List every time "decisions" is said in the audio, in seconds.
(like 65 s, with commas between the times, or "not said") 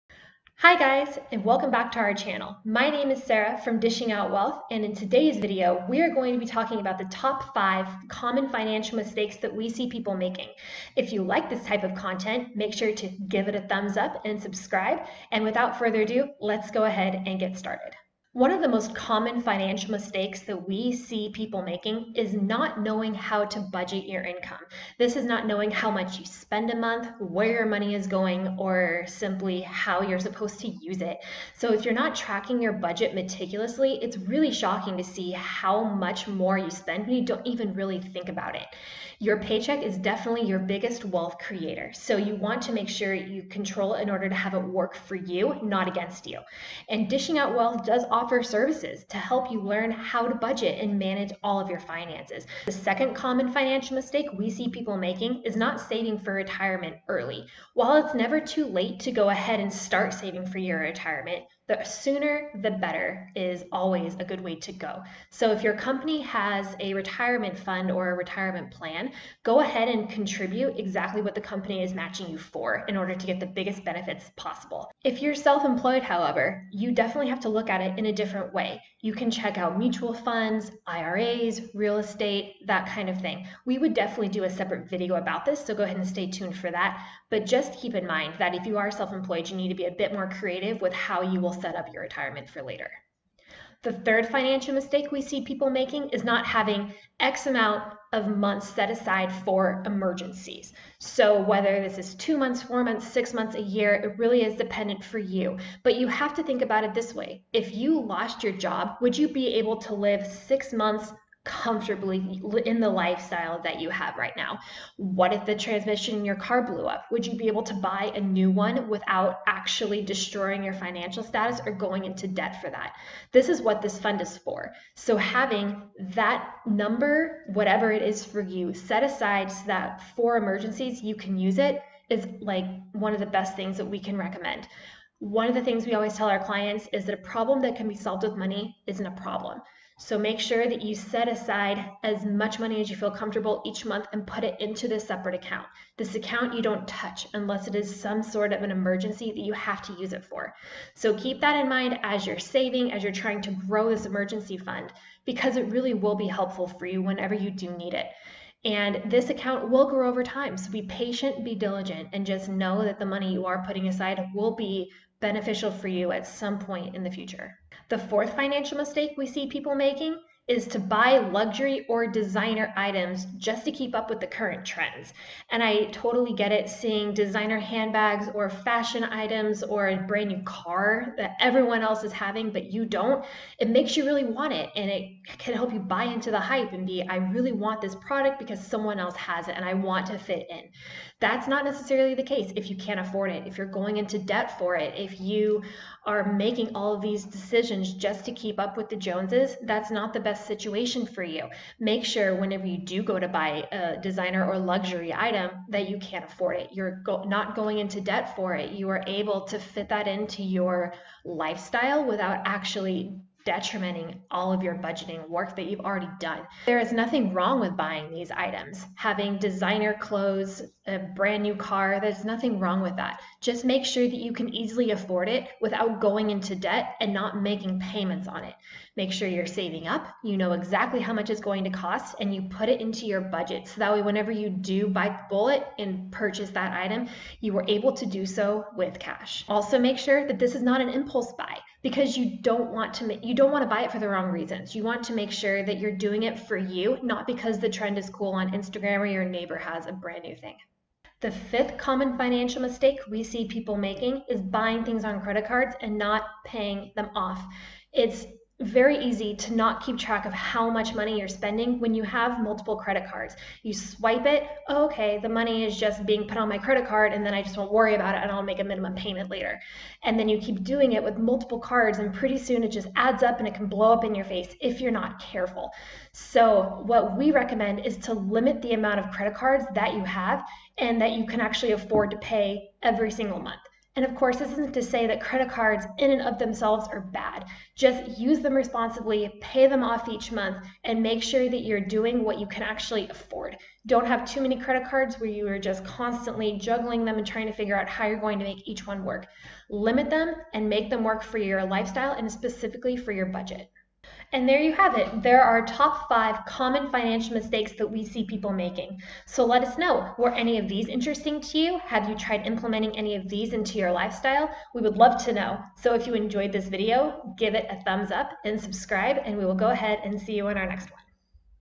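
197 s.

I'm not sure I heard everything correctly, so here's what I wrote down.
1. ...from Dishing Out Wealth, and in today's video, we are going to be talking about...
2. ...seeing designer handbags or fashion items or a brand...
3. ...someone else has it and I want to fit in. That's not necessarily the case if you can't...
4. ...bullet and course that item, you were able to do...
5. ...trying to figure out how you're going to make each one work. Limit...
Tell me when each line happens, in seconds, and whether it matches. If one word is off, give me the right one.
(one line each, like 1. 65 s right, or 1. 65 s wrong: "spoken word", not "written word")
1. 3 s right
2. 176 s right
3. 188 s right
4. 235 s wrong: "purchase", not "course"
5. 297 s right.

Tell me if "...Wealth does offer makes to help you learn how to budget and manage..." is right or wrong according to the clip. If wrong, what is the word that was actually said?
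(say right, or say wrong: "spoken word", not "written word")
wrong: "services", not "makes".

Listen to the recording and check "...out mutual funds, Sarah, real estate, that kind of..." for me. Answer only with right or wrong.
wrong.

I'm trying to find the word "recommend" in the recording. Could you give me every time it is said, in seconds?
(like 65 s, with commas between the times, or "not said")
134 s, 277 s.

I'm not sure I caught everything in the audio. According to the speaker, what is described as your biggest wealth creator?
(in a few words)
Your paycheck.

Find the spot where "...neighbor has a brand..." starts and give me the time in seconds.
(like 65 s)
249 s.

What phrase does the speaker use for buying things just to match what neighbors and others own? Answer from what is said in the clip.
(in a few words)
Keep up with the Joneses.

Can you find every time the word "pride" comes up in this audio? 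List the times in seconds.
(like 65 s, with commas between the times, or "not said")
not said.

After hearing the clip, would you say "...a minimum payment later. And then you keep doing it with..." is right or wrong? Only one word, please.
right.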